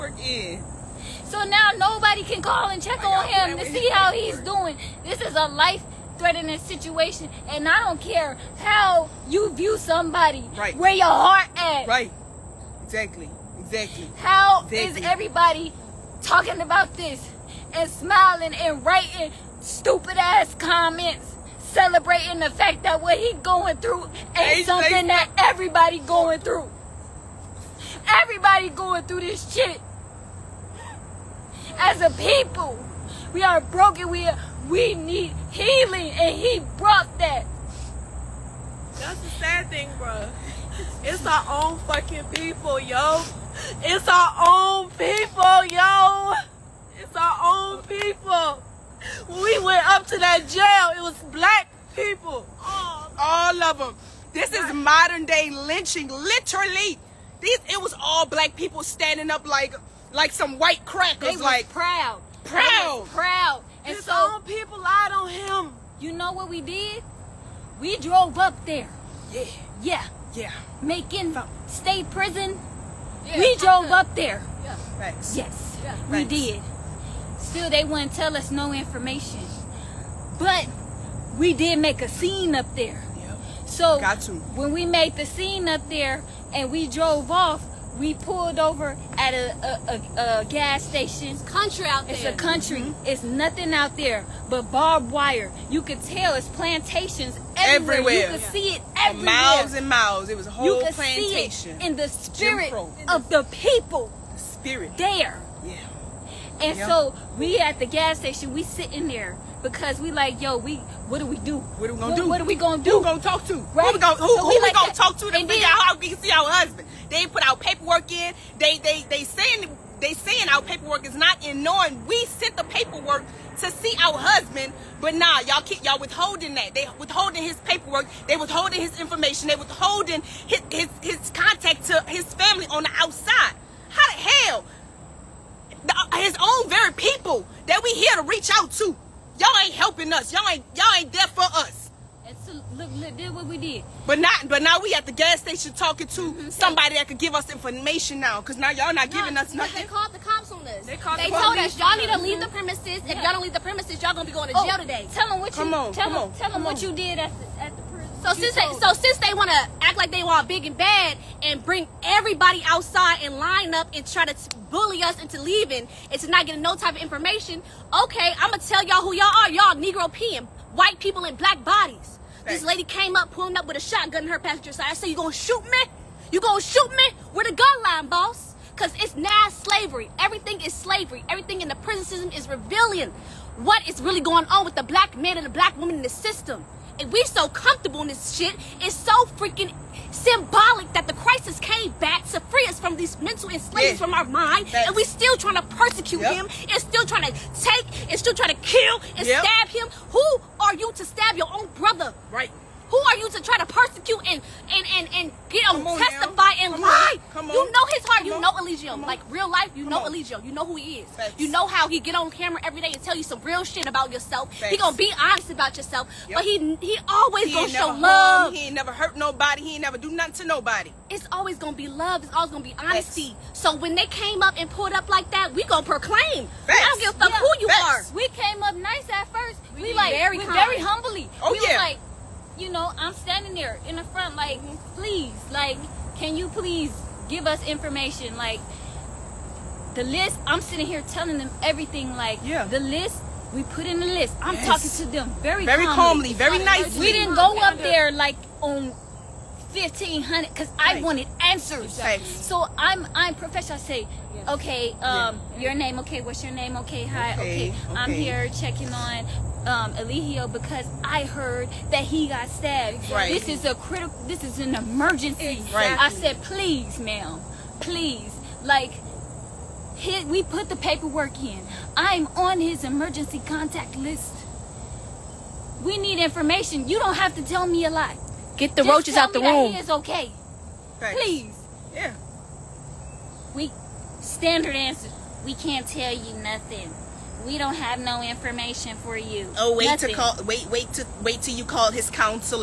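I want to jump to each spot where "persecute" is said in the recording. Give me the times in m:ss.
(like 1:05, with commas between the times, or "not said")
3:15, 3:23.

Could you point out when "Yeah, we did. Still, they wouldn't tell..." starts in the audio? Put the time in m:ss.
1:15.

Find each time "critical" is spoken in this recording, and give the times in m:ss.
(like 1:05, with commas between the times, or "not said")
4:23.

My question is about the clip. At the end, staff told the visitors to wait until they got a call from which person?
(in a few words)
his counselor.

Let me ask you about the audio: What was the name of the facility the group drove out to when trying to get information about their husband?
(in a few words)
Macon State Prison.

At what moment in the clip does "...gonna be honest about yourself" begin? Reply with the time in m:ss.
3:34.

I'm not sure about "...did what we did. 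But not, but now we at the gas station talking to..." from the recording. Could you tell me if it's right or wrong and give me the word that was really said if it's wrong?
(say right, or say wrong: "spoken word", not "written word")
right.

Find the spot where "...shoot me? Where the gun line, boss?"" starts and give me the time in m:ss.
2:56.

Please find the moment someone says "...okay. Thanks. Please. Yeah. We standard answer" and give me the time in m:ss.
4:39.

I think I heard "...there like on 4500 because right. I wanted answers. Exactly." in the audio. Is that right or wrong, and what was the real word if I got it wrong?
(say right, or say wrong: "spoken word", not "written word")
wrong: "1500", not "4500".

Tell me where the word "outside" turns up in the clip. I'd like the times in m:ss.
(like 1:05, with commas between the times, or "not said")
2:12, 2:42.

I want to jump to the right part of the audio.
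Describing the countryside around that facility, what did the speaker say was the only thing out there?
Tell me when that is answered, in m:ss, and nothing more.
1:34.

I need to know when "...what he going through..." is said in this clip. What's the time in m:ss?
0:23.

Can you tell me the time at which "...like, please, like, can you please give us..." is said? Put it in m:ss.
3:54.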